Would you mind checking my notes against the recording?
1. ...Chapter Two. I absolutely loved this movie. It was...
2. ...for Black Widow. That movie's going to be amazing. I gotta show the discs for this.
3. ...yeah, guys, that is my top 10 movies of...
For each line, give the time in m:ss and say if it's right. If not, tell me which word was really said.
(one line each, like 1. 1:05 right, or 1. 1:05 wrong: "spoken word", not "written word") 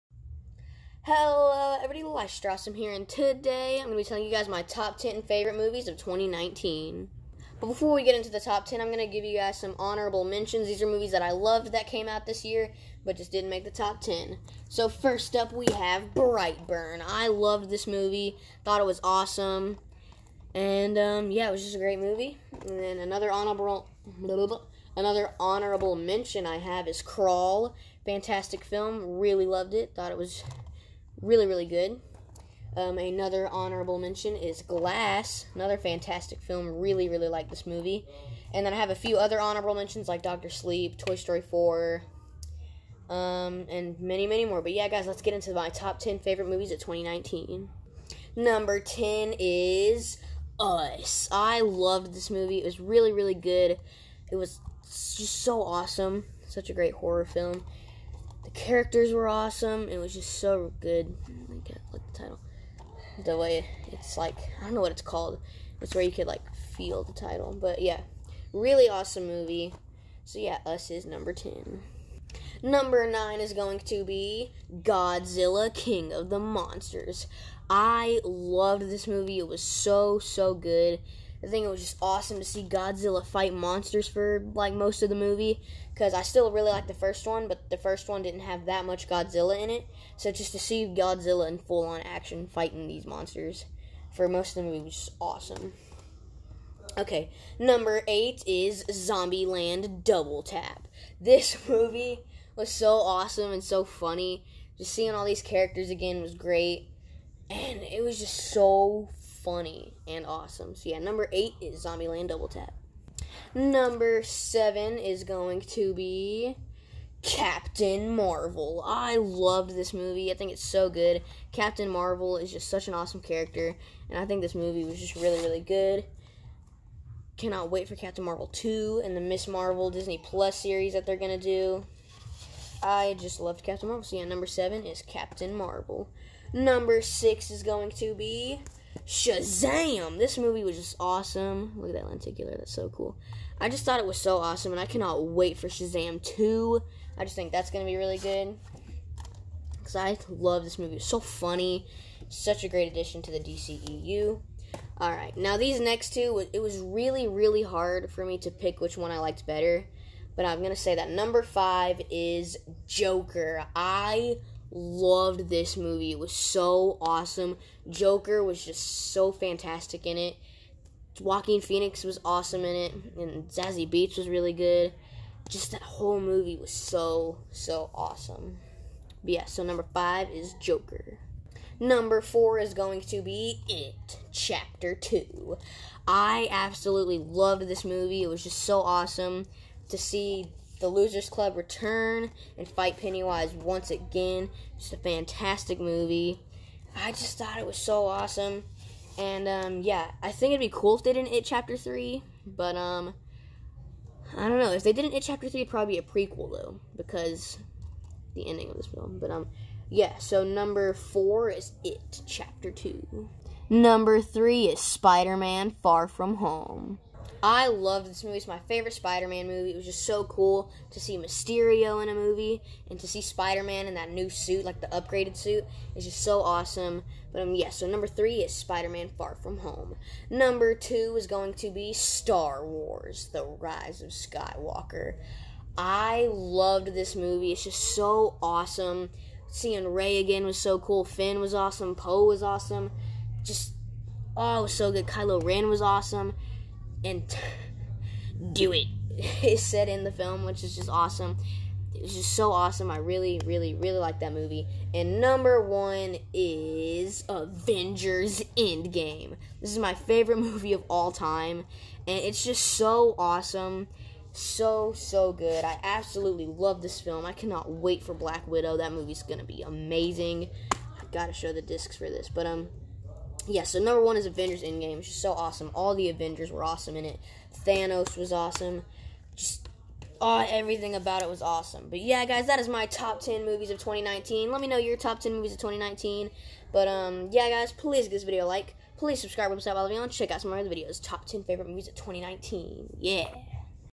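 1. 3:04 right
2. 4:28 right
3. 4:41 right.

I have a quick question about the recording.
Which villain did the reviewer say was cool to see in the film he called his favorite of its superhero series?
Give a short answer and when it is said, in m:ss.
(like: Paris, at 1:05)
Mysterio, at 3:41.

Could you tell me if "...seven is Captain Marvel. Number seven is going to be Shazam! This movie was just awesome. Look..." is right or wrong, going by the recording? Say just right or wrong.
wrong.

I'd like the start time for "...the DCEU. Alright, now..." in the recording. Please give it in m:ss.
2:33.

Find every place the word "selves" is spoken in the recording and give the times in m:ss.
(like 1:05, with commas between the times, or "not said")
not said.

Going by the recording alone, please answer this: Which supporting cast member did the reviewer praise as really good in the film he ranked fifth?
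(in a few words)
Zazie Beetz.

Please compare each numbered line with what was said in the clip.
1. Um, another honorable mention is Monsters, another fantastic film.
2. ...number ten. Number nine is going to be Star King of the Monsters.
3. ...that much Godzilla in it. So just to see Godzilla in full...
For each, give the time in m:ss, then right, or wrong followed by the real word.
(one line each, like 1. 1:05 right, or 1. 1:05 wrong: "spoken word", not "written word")
1. 0:32 wrong: "Glass", not "Monsters"
2. 1:11 wrong: "Godzilla", not "Star"
3. 1:28 right.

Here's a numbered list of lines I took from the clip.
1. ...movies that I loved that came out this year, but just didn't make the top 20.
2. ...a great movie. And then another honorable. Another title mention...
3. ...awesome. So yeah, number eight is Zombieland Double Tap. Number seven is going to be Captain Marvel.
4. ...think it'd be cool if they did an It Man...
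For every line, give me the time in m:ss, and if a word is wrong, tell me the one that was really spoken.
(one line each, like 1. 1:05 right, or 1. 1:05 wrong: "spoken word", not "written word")
1. 0:10 wrong: "10", not "20"
2. 0:21 wrong: "honorable", not "title"
3. 1:50 right
4. 3:20 wrong: "Chapter", not "Man".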